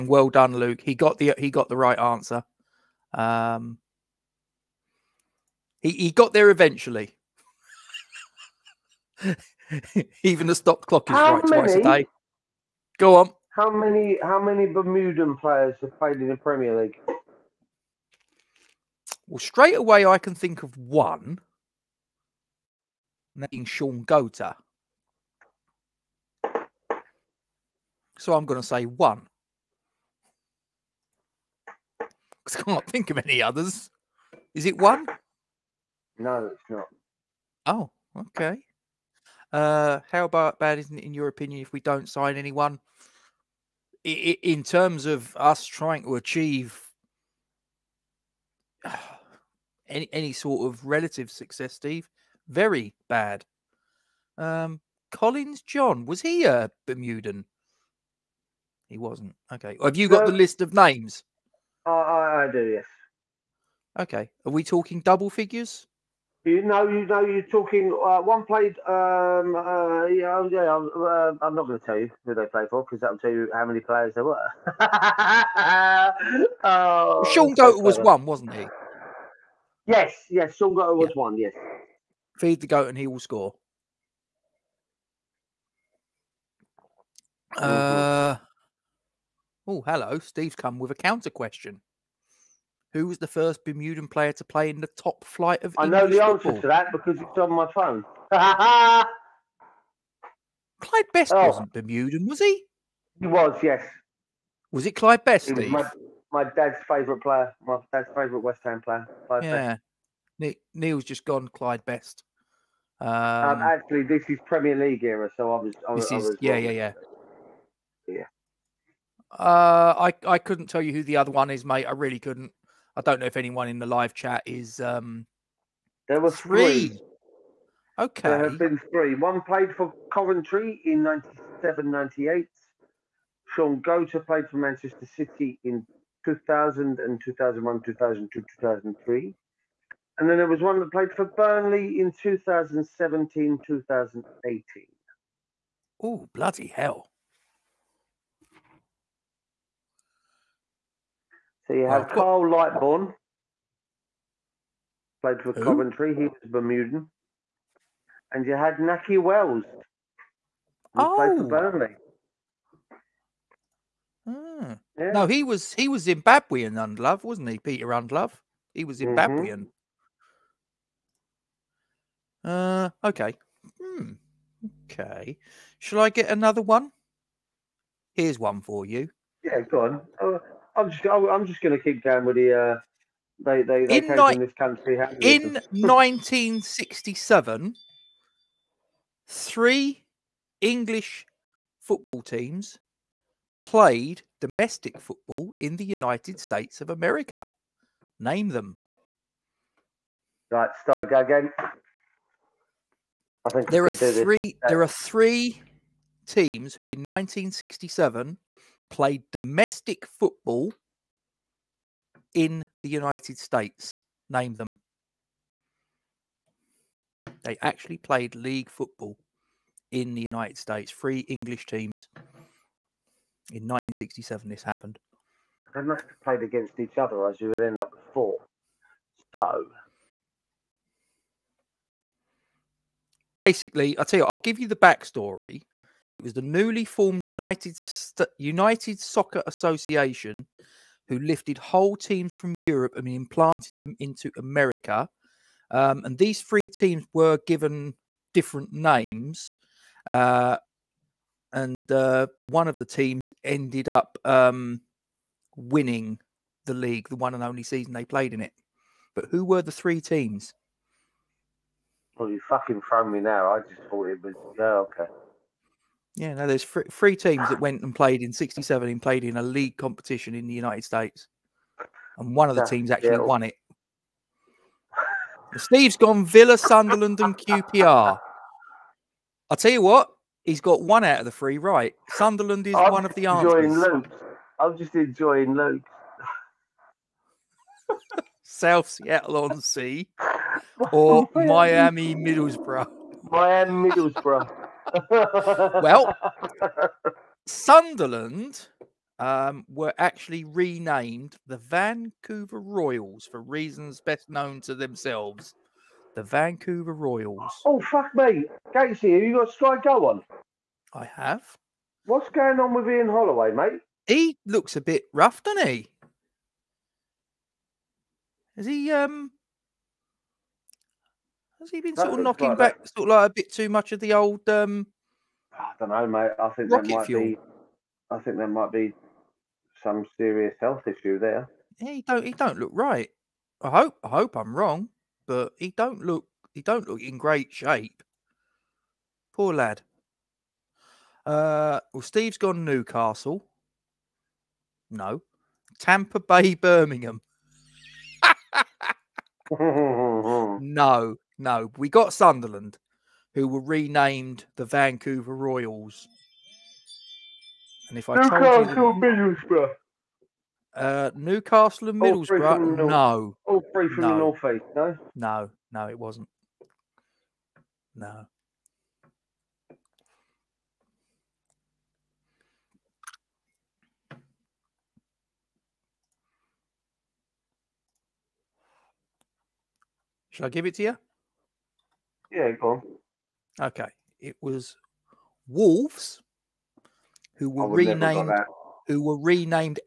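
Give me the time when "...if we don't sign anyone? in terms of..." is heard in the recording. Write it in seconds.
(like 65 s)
41 s.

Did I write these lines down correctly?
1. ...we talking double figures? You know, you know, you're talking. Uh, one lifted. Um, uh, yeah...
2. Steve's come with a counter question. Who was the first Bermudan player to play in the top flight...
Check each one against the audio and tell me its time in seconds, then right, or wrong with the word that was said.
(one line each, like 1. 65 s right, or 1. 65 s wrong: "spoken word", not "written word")
1. 64 s wrong: "played", not "lifted"
2. 90 s right.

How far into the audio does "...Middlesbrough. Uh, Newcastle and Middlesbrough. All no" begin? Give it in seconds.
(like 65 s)
359 s.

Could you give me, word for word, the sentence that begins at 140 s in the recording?
And then there was one that played for Burnley in 2017, 2018.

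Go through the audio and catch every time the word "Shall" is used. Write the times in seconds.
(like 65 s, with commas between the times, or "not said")
175 s, 380 s.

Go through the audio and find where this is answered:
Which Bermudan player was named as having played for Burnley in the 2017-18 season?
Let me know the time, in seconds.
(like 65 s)
158 s.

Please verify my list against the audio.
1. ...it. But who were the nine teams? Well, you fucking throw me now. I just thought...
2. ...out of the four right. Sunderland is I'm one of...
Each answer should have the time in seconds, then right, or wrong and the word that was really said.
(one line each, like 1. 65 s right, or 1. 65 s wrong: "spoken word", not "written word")
1. 258 s wrong: "three", not "nine"
2. 281 s wrong: "three", not "four".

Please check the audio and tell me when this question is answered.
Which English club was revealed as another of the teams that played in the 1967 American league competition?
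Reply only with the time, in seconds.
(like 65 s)
384 s.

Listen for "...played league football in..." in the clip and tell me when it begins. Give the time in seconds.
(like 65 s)
217 s.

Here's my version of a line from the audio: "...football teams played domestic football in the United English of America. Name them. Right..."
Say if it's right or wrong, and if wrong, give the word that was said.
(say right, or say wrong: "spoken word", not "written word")
wrong: "States", not "English".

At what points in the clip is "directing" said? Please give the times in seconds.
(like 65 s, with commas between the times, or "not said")
not said.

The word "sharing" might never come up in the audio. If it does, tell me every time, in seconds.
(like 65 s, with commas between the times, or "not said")
not said.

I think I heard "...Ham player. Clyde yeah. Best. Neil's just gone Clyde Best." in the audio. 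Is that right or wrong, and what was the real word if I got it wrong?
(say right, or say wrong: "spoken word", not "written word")
right.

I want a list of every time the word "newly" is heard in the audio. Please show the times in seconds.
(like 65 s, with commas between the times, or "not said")
236 s.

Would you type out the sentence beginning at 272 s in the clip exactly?
And one of the teams actually won it.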